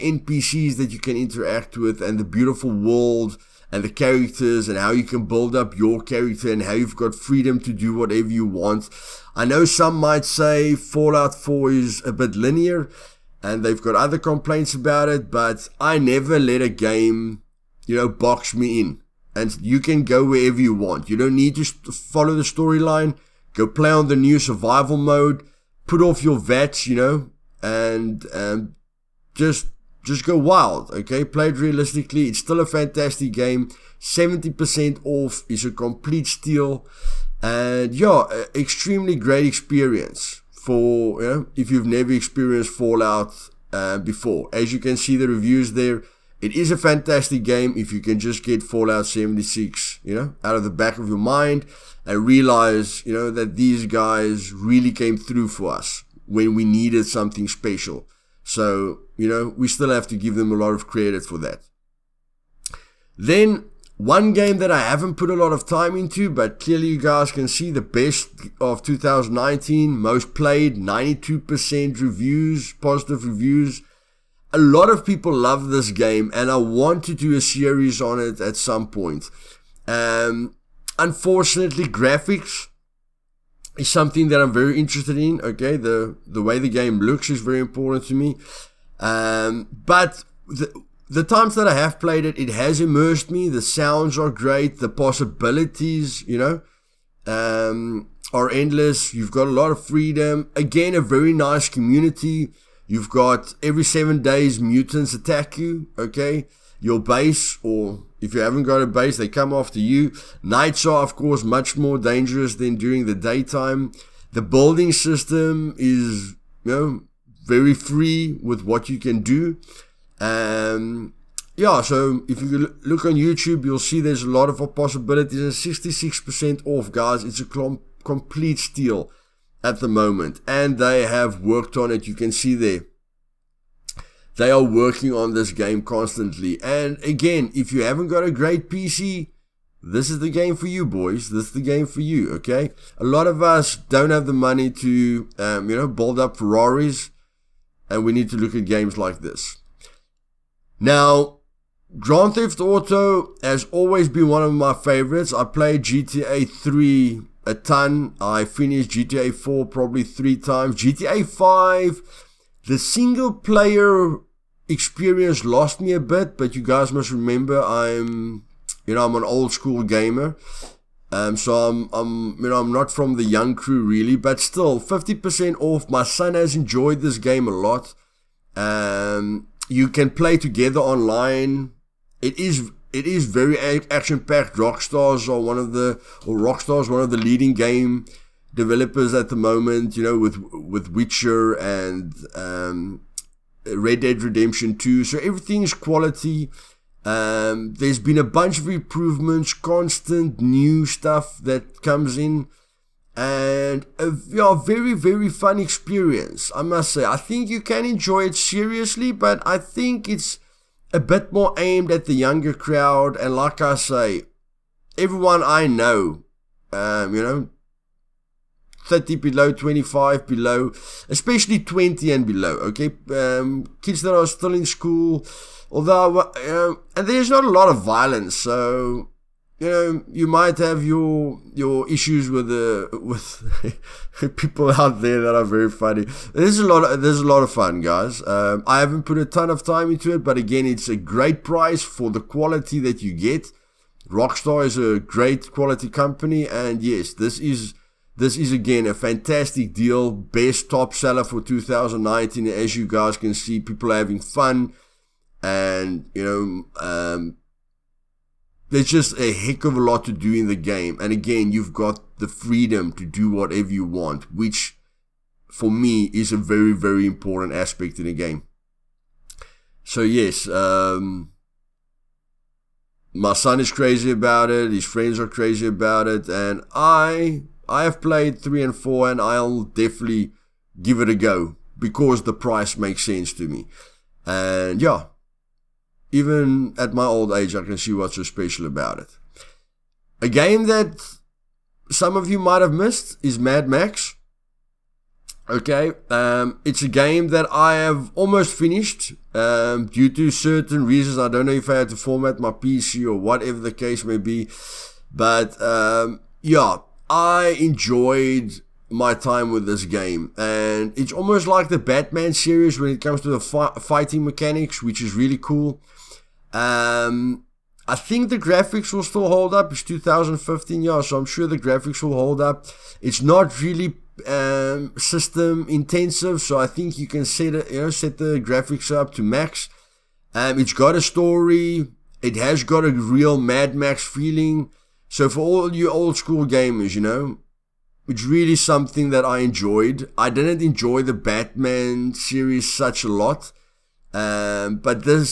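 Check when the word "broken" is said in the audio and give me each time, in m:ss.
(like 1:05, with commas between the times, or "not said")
not said.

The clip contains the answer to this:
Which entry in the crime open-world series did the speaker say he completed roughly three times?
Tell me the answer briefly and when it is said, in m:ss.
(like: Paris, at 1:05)
GTA 4, at 2:38.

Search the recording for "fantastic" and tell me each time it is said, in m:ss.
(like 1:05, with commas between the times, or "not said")
0:32, 0:46, 4:08.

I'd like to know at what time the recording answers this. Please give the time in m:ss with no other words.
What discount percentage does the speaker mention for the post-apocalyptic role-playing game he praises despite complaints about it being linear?
0:34.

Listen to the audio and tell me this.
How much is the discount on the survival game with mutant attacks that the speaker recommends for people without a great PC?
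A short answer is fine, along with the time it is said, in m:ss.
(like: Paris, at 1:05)
66%, at 2:05.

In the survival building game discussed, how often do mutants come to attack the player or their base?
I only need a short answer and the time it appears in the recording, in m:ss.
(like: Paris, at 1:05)
every 7 days, at 1:43.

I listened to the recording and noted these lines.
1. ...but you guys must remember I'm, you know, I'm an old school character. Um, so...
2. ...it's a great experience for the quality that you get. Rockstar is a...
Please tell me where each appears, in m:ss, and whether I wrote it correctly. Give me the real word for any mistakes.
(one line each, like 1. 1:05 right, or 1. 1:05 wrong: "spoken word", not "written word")
1. 2:46 wrong: "gamer", not "character"
2. 4:00 wrong: "price", not "experience".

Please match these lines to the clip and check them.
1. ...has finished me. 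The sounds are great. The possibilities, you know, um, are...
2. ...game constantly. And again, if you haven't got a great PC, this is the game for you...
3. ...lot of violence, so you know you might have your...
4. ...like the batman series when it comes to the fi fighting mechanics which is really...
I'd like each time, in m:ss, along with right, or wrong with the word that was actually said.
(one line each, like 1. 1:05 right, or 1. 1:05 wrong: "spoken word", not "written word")
1. 1:32 wrong: "immersed", not "finished"
2. 2:15 right
3. 3:47 right
4. 5:11 right.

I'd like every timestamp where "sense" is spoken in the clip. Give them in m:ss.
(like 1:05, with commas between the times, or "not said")
4:43.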